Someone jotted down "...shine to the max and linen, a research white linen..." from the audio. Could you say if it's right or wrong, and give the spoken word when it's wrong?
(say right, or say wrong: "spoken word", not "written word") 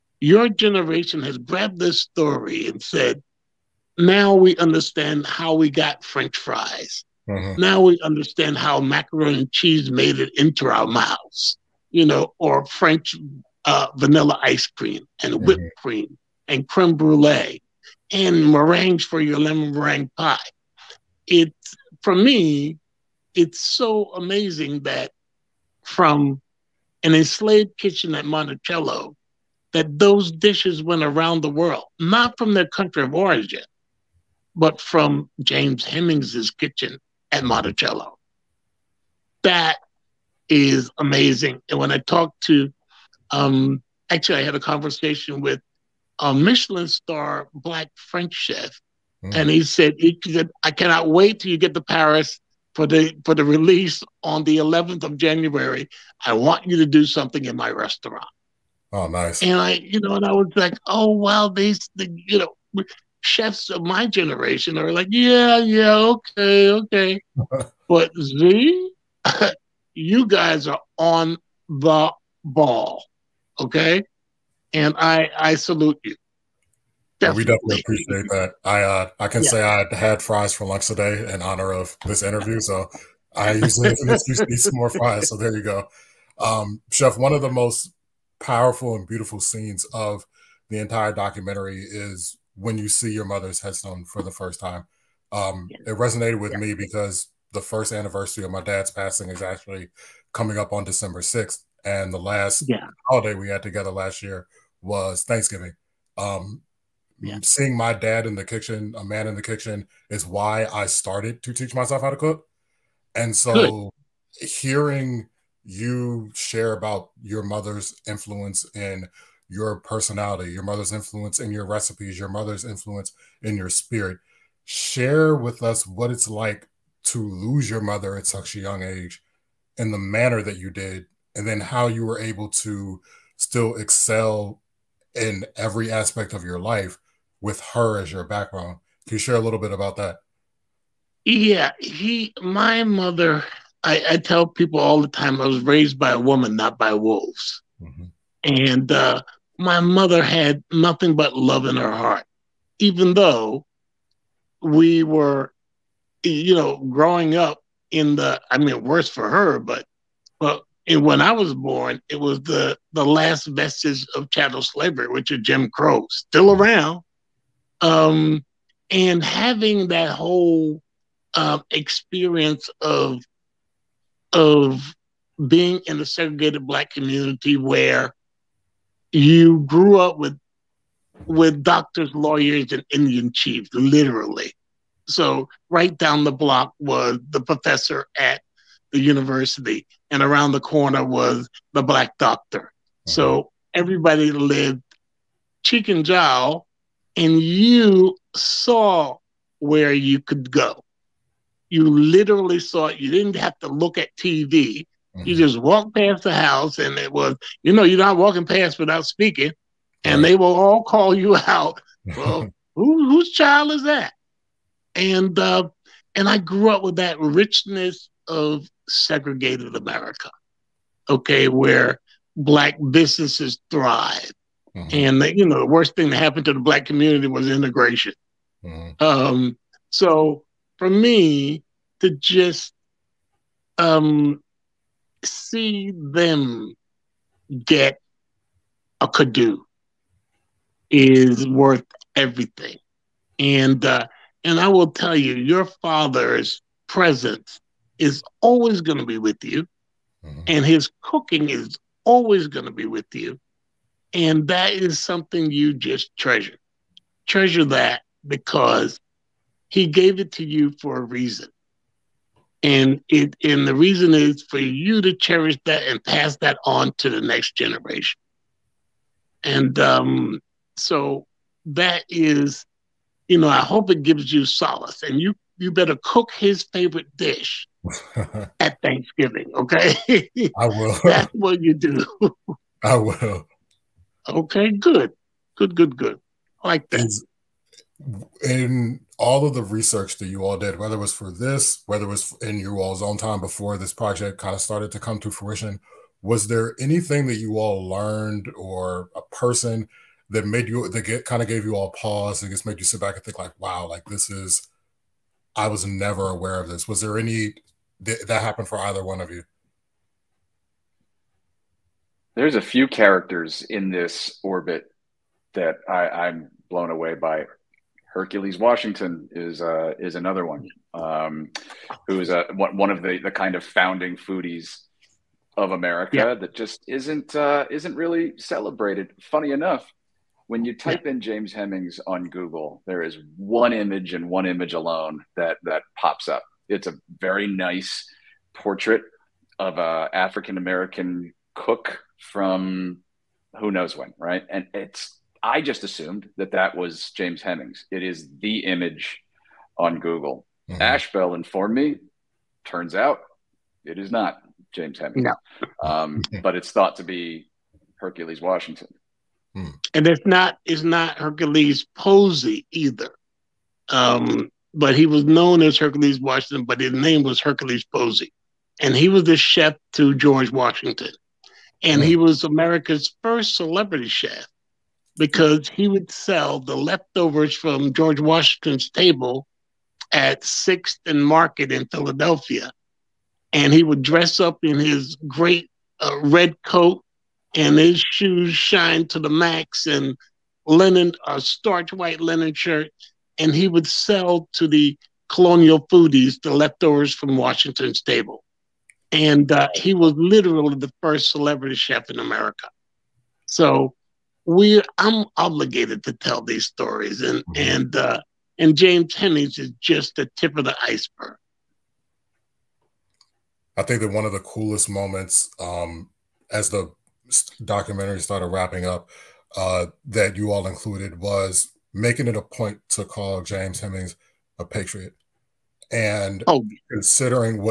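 wrong: "starch", not "research".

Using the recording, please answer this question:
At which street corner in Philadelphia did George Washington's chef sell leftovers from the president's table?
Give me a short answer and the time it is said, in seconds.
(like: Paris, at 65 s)
6th and Market, at 380 s.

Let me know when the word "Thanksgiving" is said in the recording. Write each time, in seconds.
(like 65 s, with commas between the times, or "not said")
105 s, 278 s.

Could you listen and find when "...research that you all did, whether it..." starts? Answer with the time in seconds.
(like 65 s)
289 s.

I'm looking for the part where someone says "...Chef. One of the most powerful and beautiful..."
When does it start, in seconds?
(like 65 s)
86 s.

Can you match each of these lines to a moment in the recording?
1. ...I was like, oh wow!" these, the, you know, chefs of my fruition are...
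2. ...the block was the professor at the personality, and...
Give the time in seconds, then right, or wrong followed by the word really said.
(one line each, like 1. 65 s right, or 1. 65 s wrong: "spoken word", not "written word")
1. 60 s wrong: "generation", not "fruition"
2. 186 s wrong: "university", not "personality".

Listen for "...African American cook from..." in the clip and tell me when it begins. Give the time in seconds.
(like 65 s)
340 s.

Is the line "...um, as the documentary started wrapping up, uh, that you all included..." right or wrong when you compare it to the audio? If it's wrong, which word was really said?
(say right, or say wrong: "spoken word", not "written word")
right.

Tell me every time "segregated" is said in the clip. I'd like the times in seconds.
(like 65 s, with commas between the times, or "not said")
176 s, 218 s.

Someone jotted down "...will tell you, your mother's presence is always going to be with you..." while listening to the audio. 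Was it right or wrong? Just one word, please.
wrong.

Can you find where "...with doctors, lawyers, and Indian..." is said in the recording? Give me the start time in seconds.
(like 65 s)
181 s.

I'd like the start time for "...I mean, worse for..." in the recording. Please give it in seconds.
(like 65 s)
158 s.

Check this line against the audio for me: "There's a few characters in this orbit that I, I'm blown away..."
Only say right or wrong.
right.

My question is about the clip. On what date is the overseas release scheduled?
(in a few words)
11th of January.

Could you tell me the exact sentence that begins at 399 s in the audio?
And uh, he was literally the first celebrity chef in America.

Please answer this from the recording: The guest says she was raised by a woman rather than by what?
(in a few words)
Wolves.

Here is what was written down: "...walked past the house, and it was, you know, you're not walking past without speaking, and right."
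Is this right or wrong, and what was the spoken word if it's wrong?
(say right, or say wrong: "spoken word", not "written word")
right.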